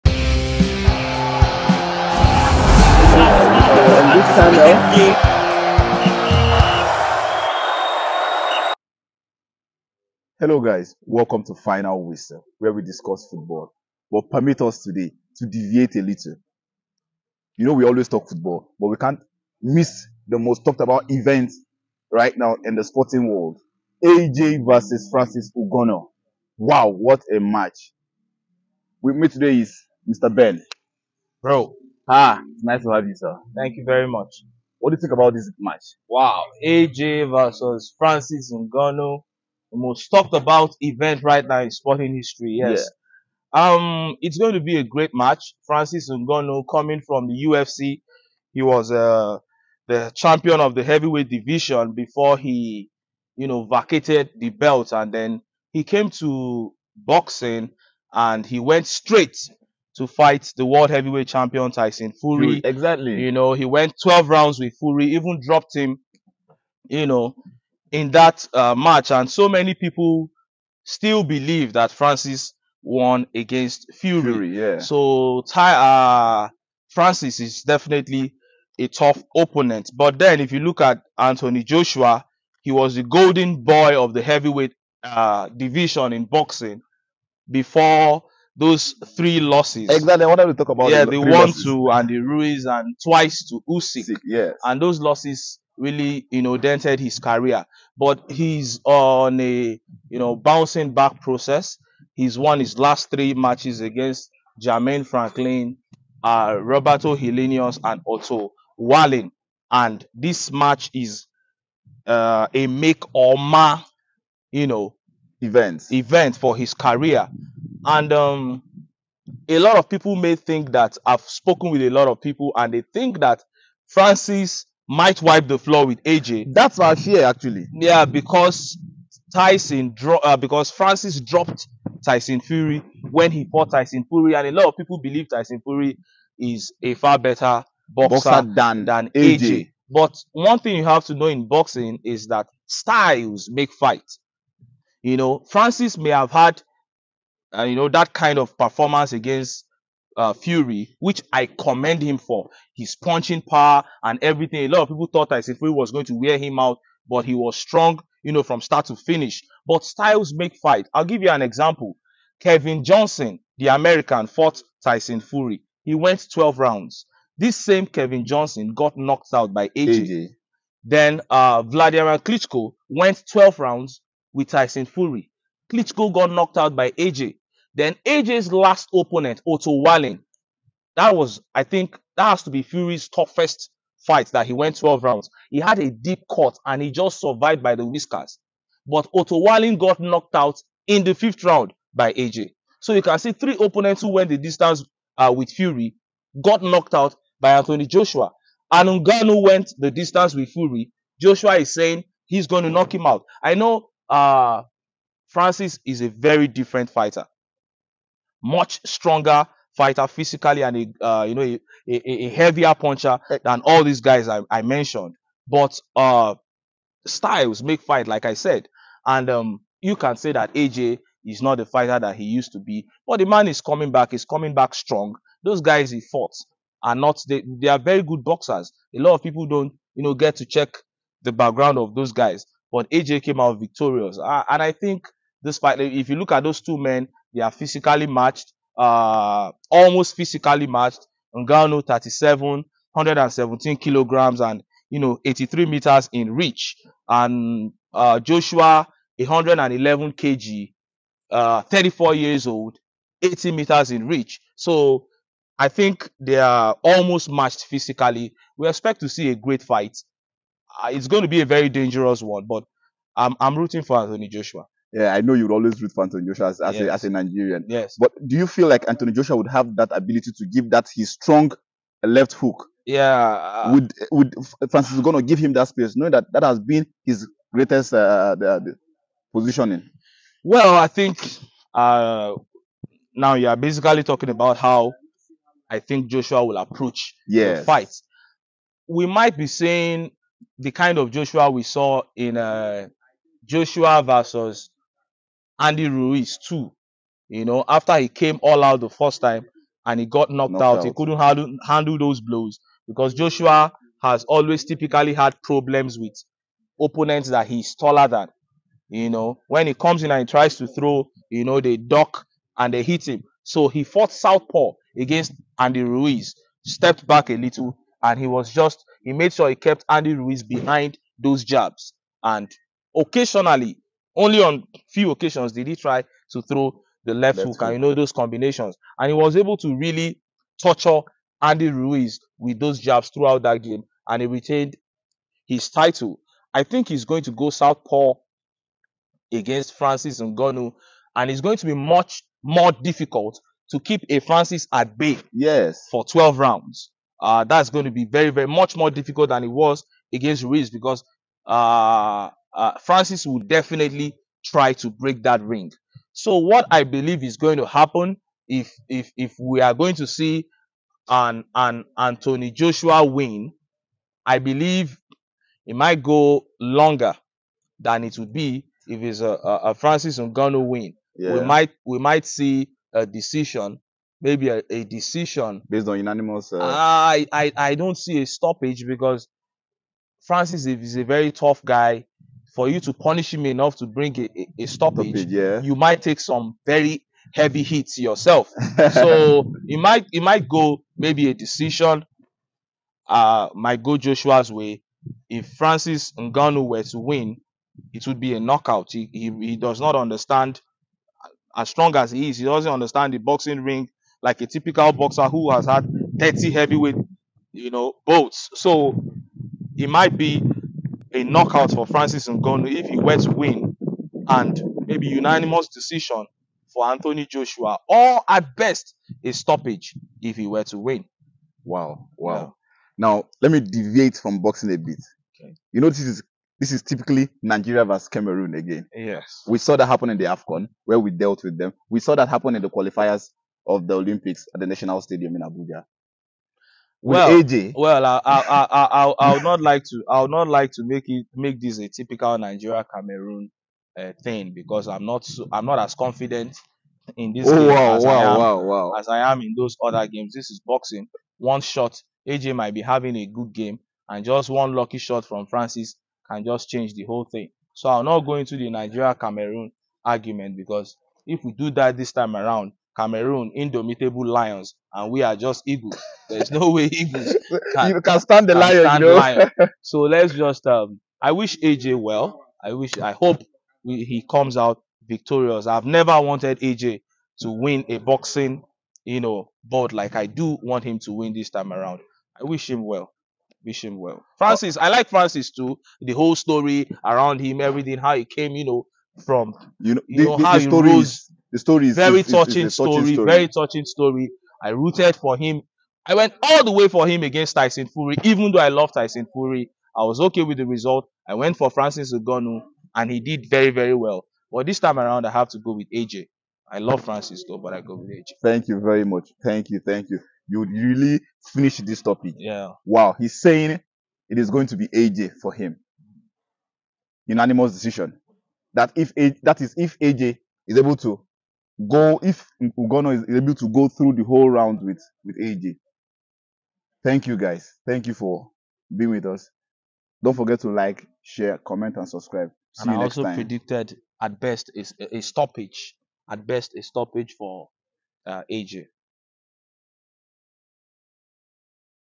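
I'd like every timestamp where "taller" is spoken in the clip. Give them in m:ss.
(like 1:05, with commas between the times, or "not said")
5:07.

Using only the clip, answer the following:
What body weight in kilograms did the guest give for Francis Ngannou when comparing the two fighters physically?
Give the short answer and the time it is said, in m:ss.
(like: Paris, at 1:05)
117 kg, at 4:02.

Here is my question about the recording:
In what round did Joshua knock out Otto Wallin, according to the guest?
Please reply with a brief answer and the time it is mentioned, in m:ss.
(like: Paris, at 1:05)
5th, at 3:11.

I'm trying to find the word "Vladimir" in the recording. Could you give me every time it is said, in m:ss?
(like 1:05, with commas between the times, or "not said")
2:51.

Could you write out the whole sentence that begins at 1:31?
to Andy Ruiz and twice to Usyk.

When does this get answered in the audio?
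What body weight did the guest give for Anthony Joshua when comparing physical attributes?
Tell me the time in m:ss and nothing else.
4:09.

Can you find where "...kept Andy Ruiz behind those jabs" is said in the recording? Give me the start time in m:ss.
5:19.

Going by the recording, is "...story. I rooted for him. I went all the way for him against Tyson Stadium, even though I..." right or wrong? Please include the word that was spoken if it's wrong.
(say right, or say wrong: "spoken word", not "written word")
wrong: "Fury", not "Stadium".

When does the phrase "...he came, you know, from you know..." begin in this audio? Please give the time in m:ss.
8:08.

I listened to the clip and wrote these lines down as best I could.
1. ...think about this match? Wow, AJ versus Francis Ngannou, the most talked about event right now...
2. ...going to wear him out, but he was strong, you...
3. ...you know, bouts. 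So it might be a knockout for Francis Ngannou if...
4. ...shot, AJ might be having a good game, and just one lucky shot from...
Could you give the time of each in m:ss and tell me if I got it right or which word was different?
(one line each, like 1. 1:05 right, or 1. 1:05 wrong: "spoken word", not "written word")
1. 0:35 right
2. 2:35 right
3. 6:47 right
4. 7:31 right.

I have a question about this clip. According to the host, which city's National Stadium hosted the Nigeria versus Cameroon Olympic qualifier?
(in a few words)
Abuja.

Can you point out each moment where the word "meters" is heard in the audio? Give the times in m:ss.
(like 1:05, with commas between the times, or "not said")
4:05, 4:13.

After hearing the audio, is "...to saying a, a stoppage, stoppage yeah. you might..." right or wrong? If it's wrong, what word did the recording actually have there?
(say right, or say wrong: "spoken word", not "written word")
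wrong: "bring", not "saying".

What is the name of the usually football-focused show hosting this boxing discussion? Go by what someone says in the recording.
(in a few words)
Final Whistle.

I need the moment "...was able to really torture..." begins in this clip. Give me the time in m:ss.
5:29.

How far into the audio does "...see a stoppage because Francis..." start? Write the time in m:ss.
6:17.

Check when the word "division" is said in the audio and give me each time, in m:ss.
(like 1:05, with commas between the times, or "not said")
0:51, 1:25.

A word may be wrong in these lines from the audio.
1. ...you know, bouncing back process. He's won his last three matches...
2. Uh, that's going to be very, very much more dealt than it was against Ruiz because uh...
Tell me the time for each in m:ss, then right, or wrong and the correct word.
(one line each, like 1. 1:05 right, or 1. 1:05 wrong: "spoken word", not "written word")
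1. 1:40 right
2. 5:47 wrong: "difficult", not "dealt".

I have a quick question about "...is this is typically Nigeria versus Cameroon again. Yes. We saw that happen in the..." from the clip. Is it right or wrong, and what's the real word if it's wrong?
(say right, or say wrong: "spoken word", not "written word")
right.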